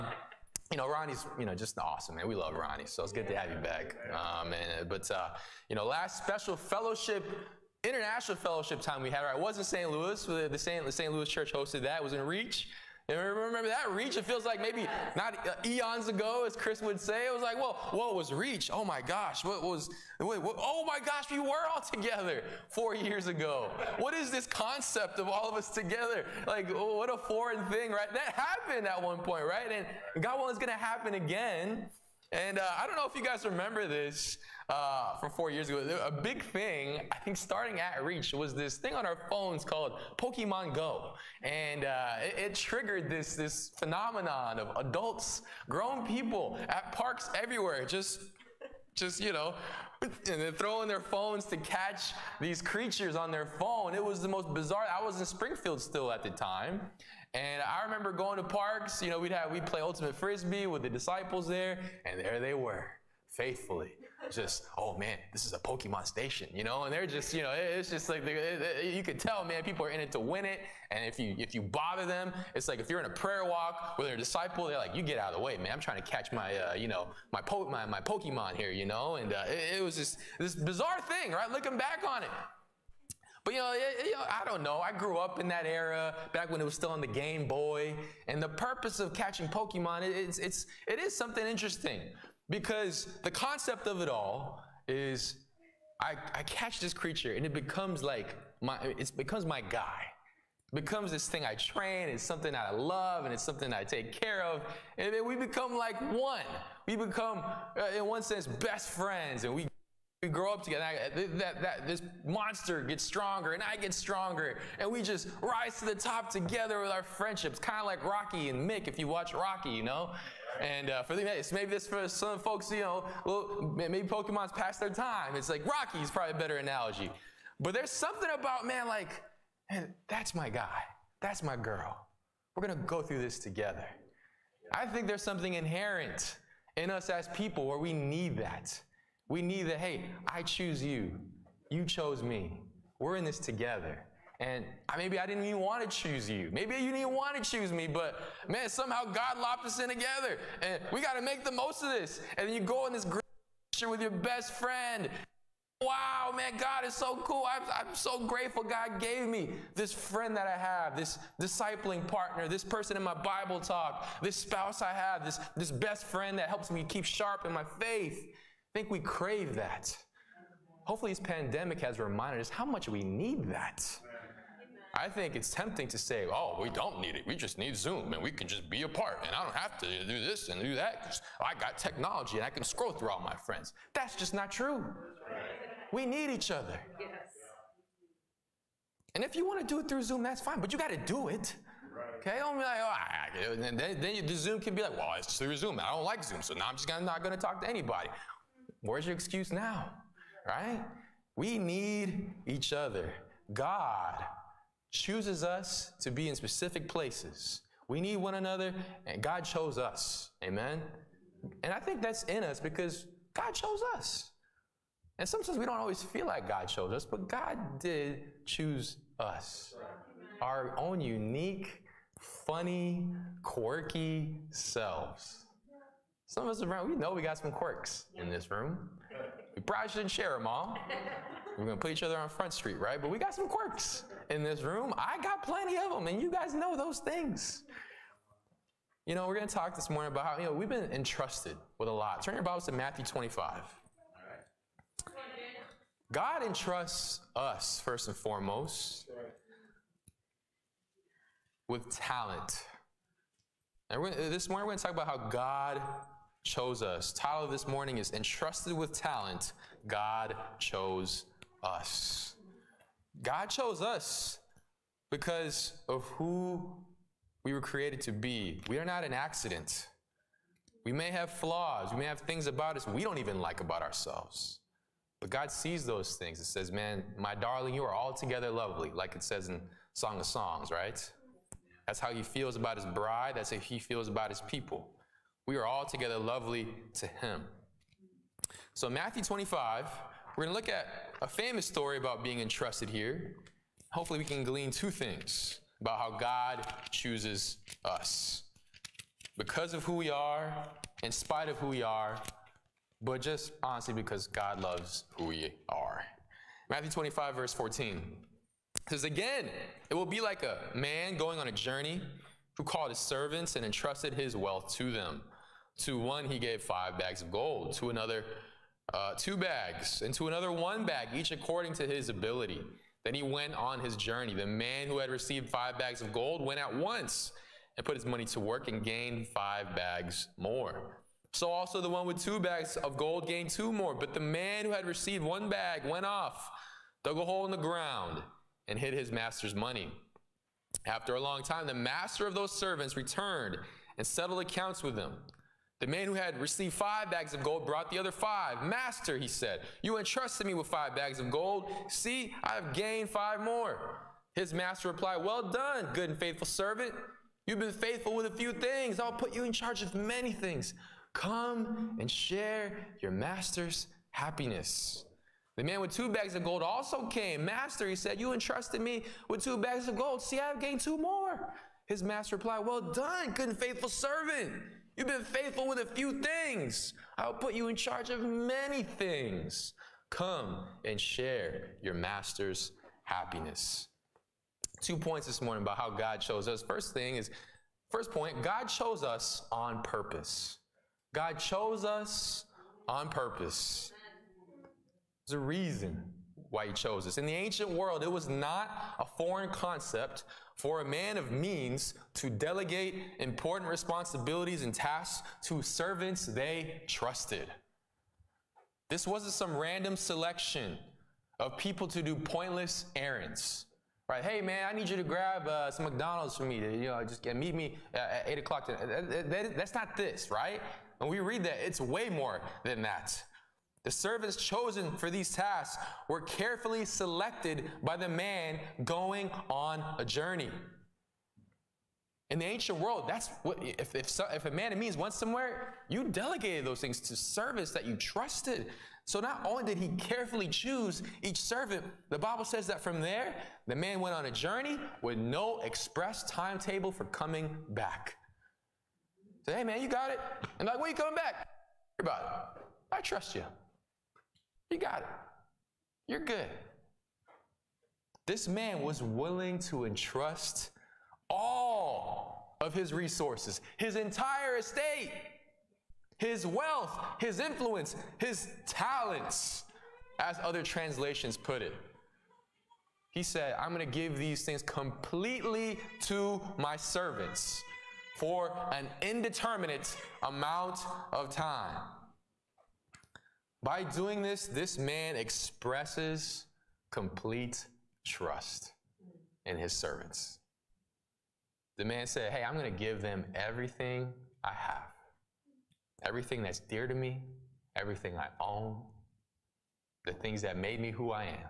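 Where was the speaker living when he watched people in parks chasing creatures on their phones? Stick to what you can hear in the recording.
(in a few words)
Springfield.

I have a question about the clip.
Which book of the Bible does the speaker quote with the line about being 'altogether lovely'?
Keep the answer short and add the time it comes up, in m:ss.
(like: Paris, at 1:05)
Song of Songs, at 4:39.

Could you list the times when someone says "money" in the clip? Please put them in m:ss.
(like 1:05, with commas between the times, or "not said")
5:28, 5:39.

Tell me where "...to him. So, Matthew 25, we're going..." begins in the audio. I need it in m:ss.
4:46.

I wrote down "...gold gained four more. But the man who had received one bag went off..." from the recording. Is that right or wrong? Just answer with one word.
wrong.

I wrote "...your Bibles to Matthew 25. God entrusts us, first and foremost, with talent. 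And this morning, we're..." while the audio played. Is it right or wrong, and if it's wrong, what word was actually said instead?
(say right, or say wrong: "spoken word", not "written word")
right.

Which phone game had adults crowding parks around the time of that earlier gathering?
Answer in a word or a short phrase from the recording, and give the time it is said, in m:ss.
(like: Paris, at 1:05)
Pokemon Go, at 0:40.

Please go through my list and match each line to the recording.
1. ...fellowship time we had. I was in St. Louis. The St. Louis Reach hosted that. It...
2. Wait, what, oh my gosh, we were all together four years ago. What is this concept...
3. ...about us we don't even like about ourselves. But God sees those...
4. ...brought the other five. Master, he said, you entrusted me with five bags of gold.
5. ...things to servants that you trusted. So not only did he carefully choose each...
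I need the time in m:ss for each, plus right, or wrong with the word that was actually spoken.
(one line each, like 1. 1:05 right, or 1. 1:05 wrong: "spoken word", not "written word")
1. 0:08 wrong: "Church", not "Reach"
2. 0:20 right
3. 4:32 right
4. 5:47 right
5. 7:16 right.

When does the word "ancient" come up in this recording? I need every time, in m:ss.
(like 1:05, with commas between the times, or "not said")
6:37, 7:12.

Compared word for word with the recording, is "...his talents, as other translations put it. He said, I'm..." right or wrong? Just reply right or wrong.
right.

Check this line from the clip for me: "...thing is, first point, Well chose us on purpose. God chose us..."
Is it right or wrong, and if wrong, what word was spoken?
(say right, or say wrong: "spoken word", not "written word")
wrong: "God", not "Well".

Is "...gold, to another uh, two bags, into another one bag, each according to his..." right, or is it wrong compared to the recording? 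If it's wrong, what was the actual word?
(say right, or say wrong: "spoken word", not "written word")
right.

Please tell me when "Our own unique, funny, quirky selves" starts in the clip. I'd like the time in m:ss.
3:40.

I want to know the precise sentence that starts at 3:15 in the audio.
I don't like Zoom, so now I'm just gonna, not going to talk to anybody.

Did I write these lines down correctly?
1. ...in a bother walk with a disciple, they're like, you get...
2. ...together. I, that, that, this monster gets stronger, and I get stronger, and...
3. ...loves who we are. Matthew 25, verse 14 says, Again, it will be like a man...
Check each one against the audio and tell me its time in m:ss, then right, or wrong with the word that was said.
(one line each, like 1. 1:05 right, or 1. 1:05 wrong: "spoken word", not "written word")
1. 1:12 wrong: "prayer", not "bother"
2. 1:50 right
3. 5:04 right.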